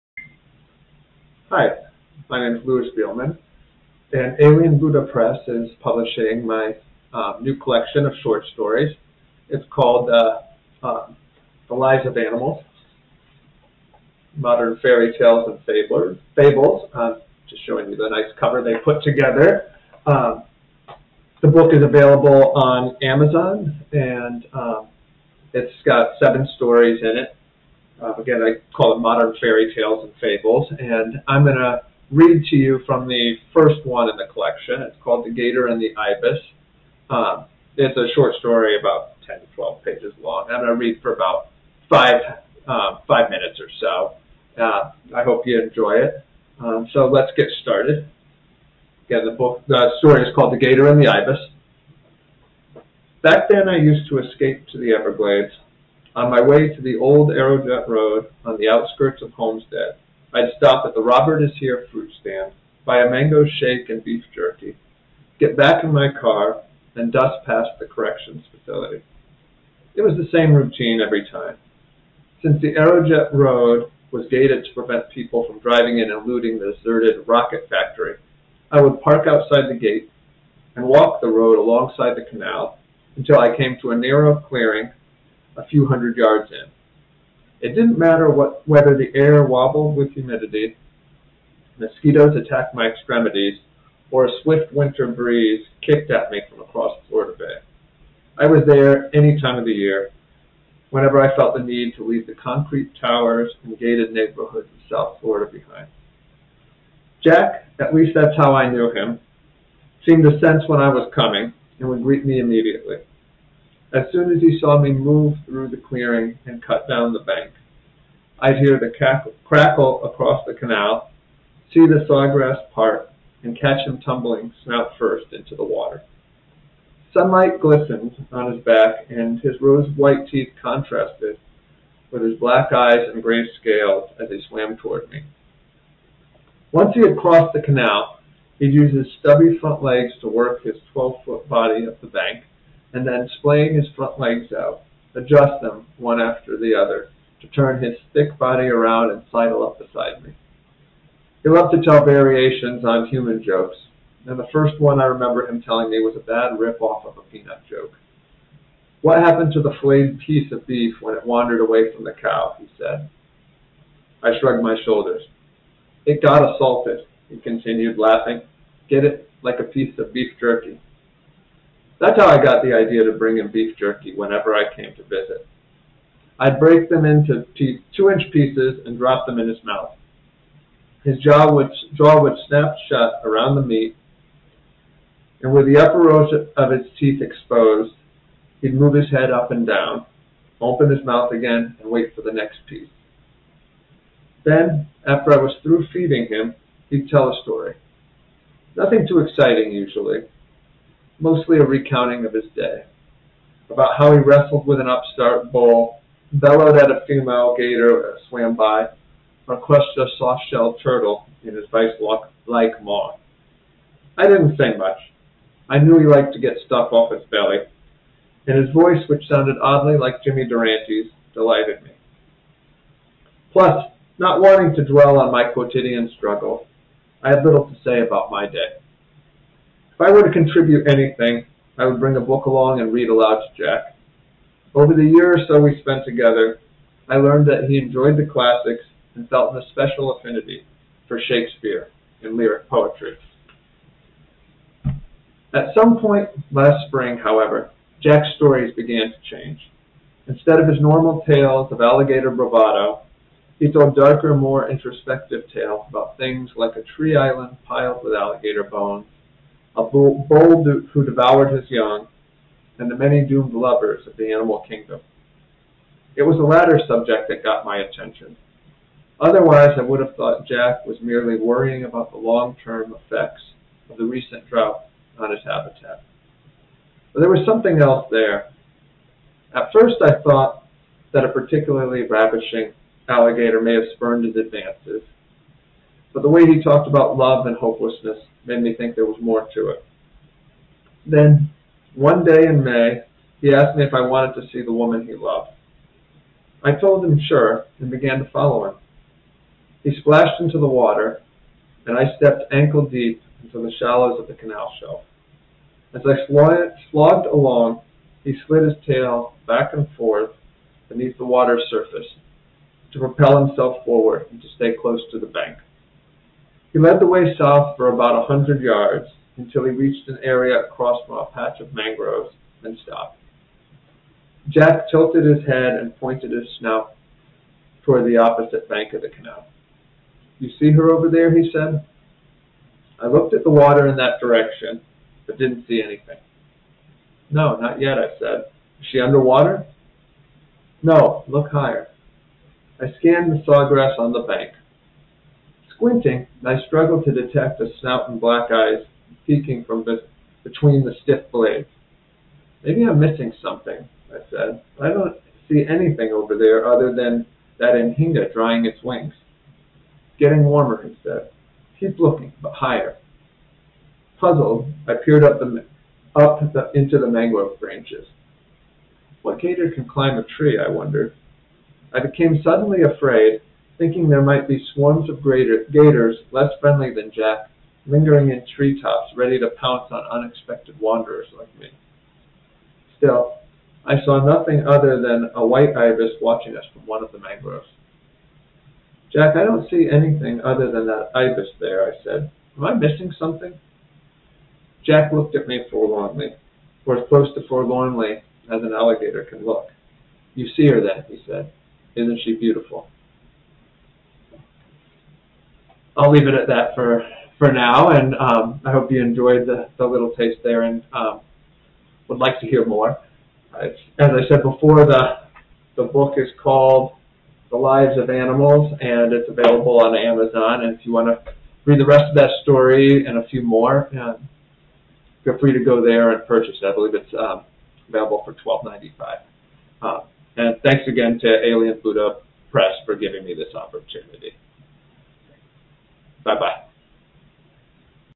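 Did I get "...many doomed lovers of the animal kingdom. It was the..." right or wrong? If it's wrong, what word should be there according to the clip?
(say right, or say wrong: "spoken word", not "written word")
right.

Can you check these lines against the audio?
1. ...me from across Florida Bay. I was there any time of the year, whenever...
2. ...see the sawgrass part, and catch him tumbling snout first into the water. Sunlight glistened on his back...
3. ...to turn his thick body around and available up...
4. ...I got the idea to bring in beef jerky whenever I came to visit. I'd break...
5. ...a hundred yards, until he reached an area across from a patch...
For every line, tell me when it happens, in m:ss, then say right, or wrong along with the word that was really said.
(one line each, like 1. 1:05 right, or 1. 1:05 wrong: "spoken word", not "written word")
1. 1:36 right
2. 2:01 right
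3. 2:27 wrong: "sidle", not "available"
4. 2:52 right
5. 5:18 right.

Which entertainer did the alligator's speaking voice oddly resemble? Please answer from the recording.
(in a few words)
Jimmy Durante.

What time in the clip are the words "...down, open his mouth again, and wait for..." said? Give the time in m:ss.
3:09.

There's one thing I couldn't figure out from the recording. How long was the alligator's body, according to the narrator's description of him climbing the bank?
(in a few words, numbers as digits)
12 feet.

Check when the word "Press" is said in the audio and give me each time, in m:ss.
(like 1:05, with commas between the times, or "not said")
0:05, 7:12.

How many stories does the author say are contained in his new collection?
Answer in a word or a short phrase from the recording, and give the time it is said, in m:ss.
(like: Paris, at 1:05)
7, at 0:26.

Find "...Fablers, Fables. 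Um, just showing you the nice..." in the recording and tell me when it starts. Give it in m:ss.
0:15.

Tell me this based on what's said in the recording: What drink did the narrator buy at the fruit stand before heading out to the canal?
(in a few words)
Mango shake.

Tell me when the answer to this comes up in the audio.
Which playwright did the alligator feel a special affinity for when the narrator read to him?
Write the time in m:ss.
4:01.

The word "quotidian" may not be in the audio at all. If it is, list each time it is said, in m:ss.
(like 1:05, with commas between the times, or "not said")
3:45.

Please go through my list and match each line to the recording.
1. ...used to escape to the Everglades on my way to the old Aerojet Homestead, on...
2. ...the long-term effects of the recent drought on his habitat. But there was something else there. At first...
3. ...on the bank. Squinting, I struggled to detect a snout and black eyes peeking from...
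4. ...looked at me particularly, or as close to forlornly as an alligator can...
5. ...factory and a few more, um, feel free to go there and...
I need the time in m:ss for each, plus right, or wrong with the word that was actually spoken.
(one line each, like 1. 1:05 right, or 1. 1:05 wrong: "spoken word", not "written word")
1. 0:53 wrong: "Road", not "Homestead"
2. 4:32 right
3. 5:43 right
4. 6:35 wrong: "forlornly", not "particularly"
5. 7:02 wrong: "story", not "factory".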